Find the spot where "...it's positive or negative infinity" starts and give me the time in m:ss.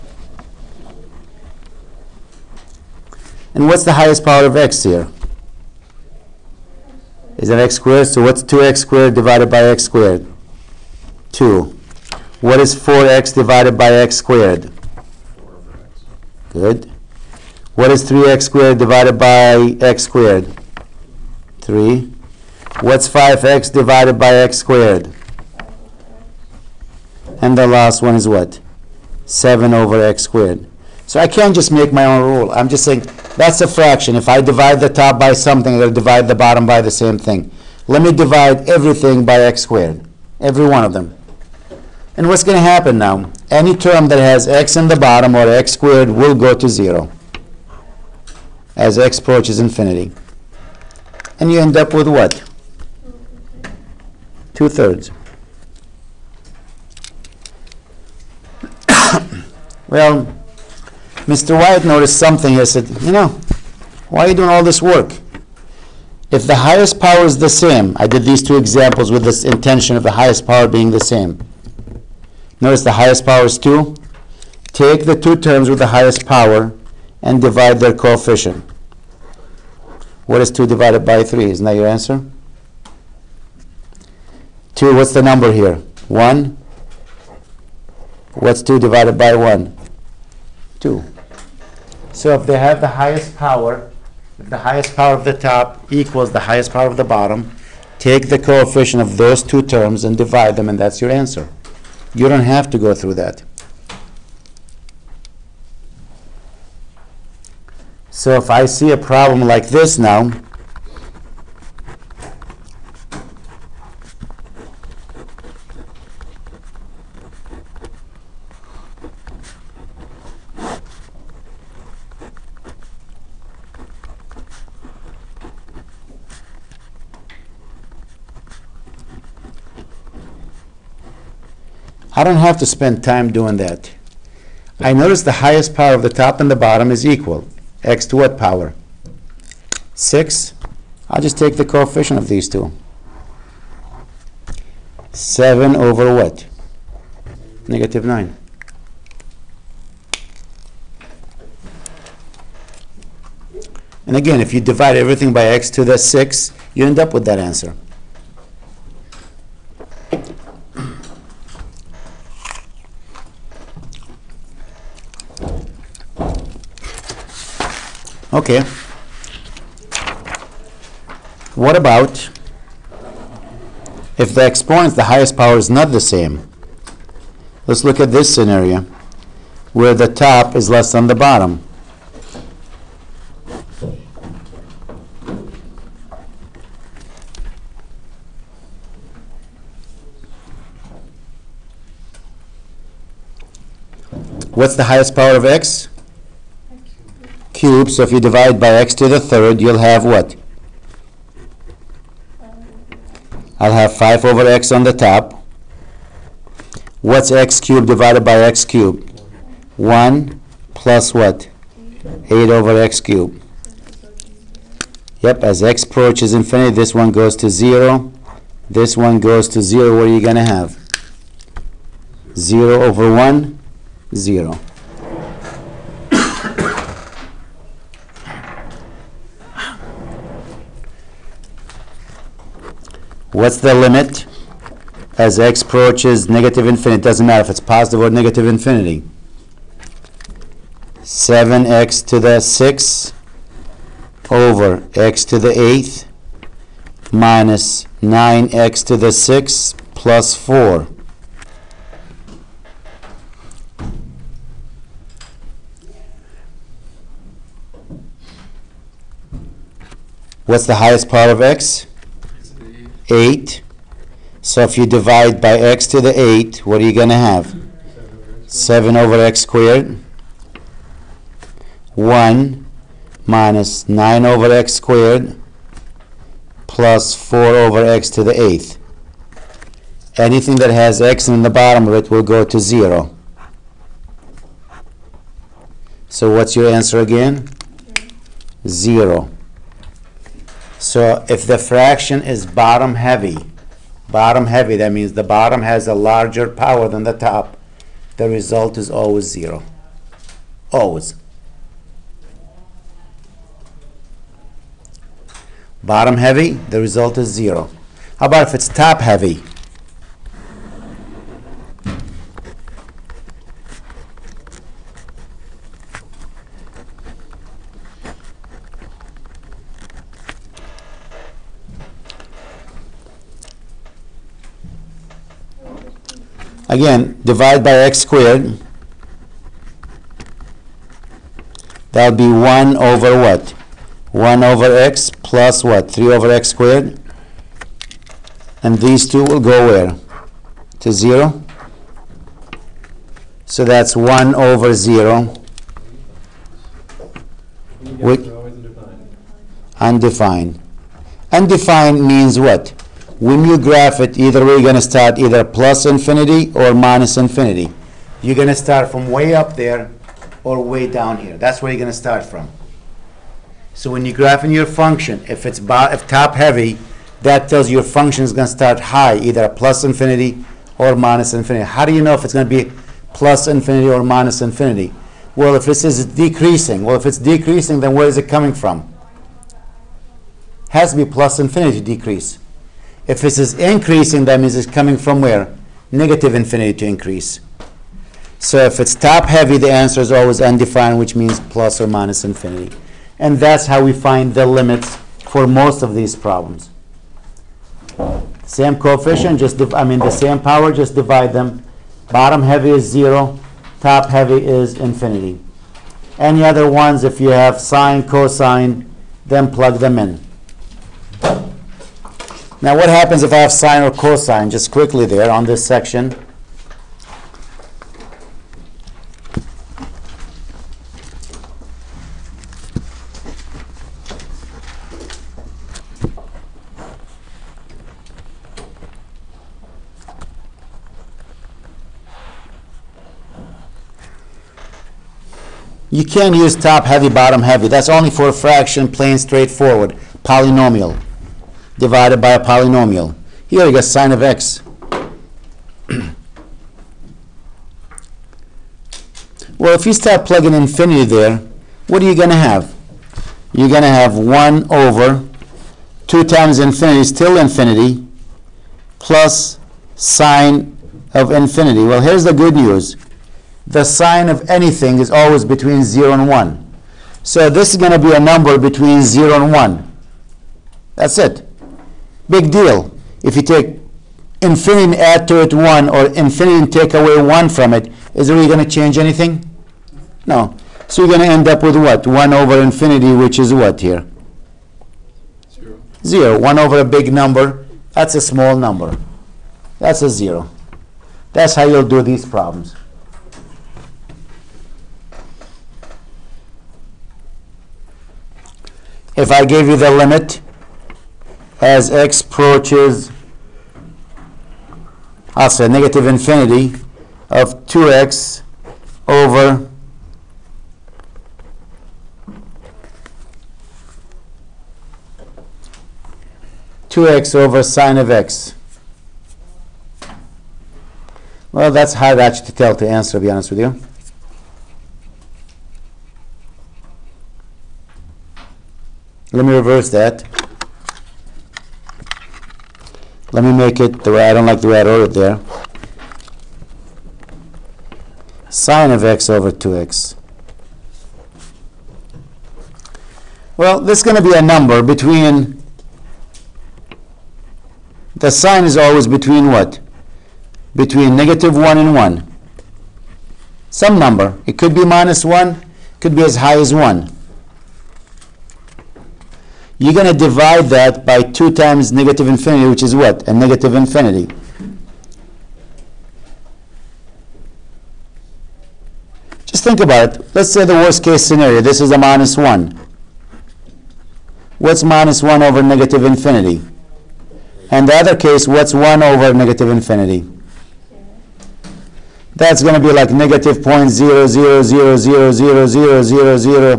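3:57.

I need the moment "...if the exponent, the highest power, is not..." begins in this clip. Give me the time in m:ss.
2:54.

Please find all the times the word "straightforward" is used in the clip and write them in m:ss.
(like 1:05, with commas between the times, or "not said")
7:19.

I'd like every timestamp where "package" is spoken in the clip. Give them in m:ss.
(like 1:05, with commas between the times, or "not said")
not said.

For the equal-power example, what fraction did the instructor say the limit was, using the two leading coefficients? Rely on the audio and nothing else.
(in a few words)
7 over -9.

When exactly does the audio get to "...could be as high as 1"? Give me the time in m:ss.
9:16.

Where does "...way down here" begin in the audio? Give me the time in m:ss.
6:00.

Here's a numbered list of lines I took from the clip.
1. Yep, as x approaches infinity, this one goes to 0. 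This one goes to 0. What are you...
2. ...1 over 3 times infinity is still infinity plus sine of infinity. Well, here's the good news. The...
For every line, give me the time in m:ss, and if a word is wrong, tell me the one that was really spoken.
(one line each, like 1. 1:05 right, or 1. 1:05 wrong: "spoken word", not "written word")
1. 3:35 right
2. 7:34 wrong: "2", not "3".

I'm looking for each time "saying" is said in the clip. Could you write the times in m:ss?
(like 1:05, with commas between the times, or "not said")
0:32.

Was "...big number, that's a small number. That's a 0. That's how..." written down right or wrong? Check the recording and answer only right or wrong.
right.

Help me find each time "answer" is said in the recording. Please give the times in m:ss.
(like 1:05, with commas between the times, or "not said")
1:21, 1:41, 2:37, 4:46, 6:29, 8:42.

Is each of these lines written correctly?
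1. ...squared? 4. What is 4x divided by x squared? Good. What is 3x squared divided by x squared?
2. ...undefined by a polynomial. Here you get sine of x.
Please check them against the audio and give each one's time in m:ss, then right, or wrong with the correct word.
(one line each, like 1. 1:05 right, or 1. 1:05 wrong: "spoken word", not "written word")
1. 0:09 wrong: "2", not "4"
2. 7:21 wrong: "divided", not "undefined".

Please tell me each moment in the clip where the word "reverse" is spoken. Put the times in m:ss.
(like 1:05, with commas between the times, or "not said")
8:49.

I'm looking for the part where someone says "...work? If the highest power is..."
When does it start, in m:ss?
1:04.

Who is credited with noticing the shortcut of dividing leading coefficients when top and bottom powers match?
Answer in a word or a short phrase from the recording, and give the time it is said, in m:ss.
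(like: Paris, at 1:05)
Mr. Wyatt, at 1:01.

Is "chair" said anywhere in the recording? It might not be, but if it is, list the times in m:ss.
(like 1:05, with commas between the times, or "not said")
not said.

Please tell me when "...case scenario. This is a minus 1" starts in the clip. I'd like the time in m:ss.
9:31.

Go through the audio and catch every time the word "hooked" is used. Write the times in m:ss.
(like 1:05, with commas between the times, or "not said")
not said.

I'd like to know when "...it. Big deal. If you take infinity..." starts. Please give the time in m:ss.
7:51.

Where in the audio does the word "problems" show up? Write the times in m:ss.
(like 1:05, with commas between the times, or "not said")
1:48, 6:36, 8:12.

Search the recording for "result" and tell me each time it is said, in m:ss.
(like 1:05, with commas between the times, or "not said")
4:58, 5:06.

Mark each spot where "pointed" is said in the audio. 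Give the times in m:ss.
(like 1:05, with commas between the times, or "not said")
not said.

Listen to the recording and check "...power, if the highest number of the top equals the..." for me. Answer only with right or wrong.
wrong.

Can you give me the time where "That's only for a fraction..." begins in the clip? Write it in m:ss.
7:17.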